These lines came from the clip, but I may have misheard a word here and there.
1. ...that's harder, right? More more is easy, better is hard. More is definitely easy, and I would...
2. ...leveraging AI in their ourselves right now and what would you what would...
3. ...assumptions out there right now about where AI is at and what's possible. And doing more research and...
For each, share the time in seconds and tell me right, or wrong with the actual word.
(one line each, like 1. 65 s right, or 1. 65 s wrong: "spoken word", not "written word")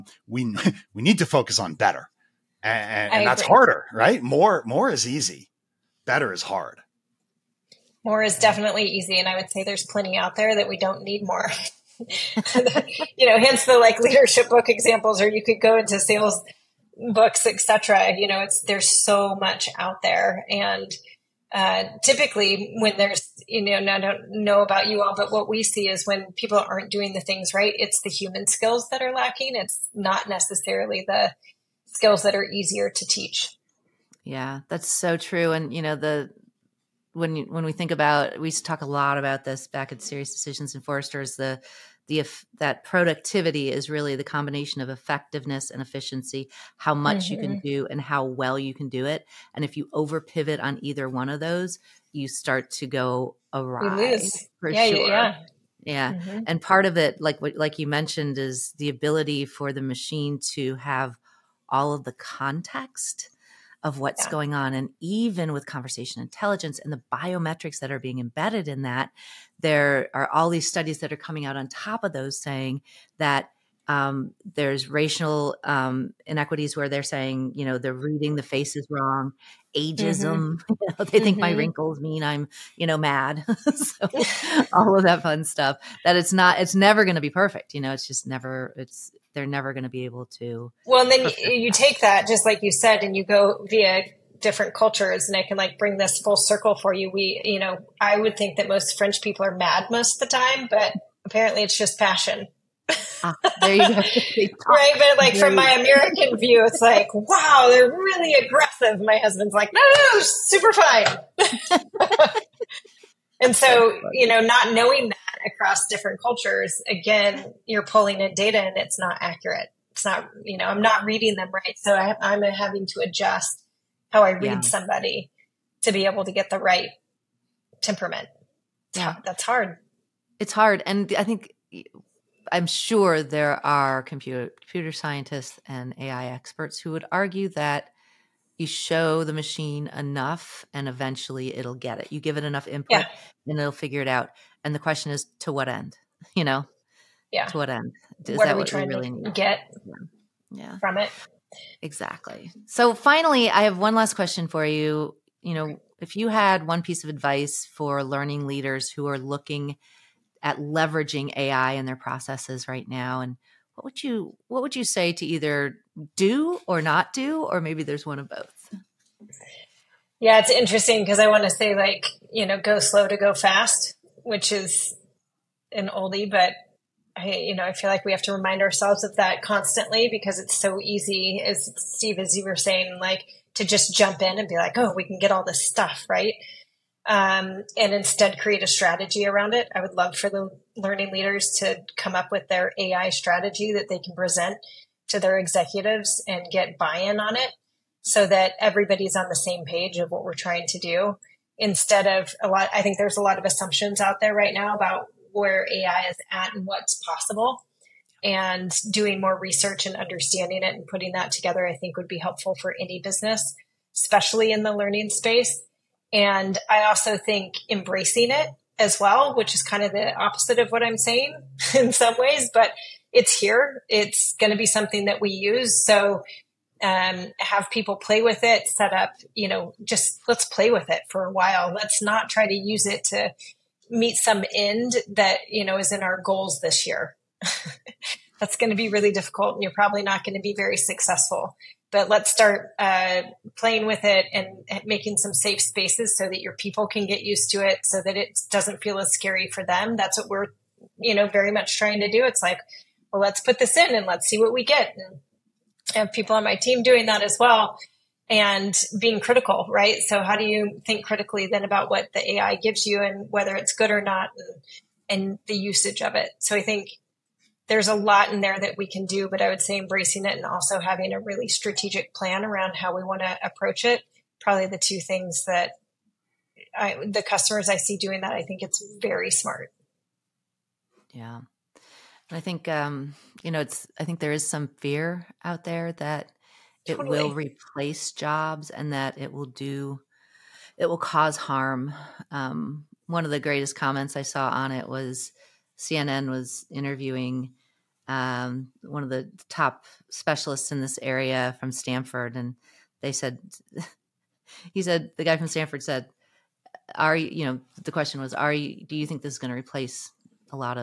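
1. 3 s right
2. 160 s wrong: "processes", not "ourselves"
3. 203 s right.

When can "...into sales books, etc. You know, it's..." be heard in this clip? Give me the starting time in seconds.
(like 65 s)
15 s.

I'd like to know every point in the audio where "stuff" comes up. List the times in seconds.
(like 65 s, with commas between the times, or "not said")
85 s, 185 s.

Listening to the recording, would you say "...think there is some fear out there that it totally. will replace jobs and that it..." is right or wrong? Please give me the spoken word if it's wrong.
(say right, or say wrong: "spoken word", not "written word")
right.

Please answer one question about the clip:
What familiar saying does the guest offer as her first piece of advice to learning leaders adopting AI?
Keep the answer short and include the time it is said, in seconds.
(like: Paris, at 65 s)
Go slow to go fast, at 172 s.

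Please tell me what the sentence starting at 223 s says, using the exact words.
It's going to be something that we use.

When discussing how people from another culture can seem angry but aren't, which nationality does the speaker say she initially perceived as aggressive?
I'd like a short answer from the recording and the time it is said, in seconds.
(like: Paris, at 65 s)
French, at 98 s.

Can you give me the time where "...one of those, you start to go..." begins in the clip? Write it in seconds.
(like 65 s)
51 s.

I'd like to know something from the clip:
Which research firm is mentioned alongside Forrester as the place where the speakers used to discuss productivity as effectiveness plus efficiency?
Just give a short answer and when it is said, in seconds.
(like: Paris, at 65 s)
SiriusDecisions, at 39 s.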